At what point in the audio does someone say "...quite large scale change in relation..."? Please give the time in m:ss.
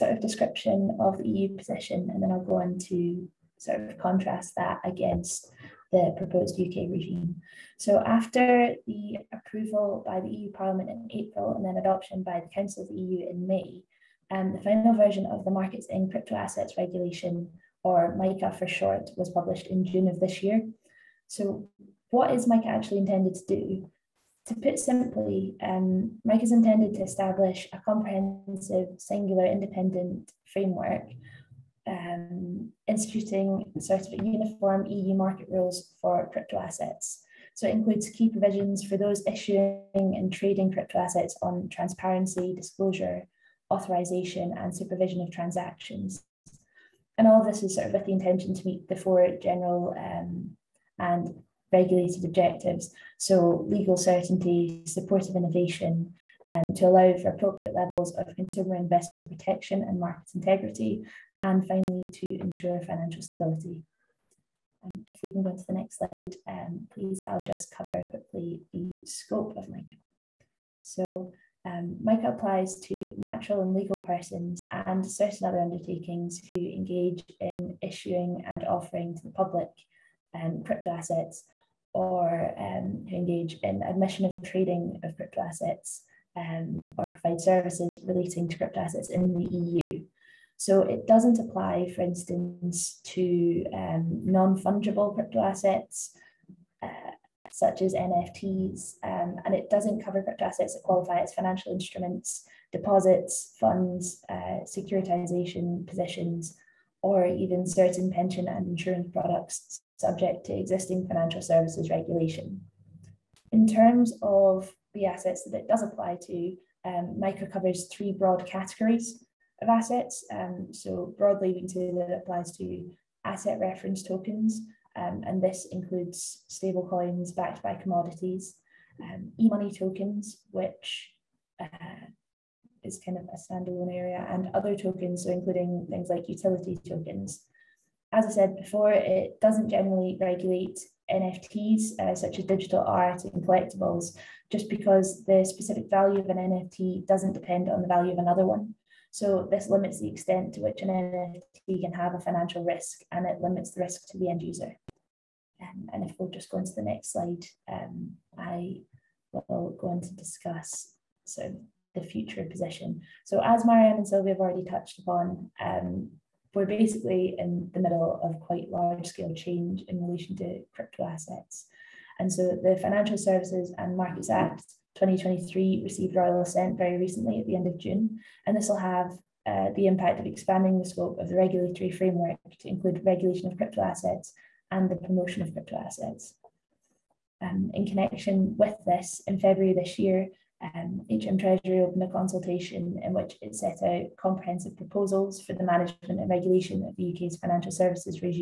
2:48.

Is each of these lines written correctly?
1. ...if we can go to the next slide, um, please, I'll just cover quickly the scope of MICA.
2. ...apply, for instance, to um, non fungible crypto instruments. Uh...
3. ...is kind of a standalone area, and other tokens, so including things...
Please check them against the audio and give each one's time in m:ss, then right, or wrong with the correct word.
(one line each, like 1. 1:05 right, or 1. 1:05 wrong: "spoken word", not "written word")
1. 1:05 right
2. 1:31 wrong: "assets", not "instruments"
3. 2:12 right.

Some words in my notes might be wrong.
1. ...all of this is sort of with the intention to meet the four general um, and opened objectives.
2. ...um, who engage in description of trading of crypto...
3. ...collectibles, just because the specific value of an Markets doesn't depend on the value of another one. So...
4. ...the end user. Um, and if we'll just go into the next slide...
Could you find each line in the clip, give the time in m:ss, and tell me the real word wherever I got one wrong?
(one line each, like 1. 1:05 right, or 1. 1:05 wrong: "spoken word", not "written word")
1. 0:47 wrong: "regulated", not "opened"
2. 1:22 wrong: "admission", not "description"
3. 2:23 wrong: "NFT", not "Markets"
4. 2:34 right.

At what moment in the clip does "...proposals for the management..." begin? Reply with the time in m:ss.
3:14.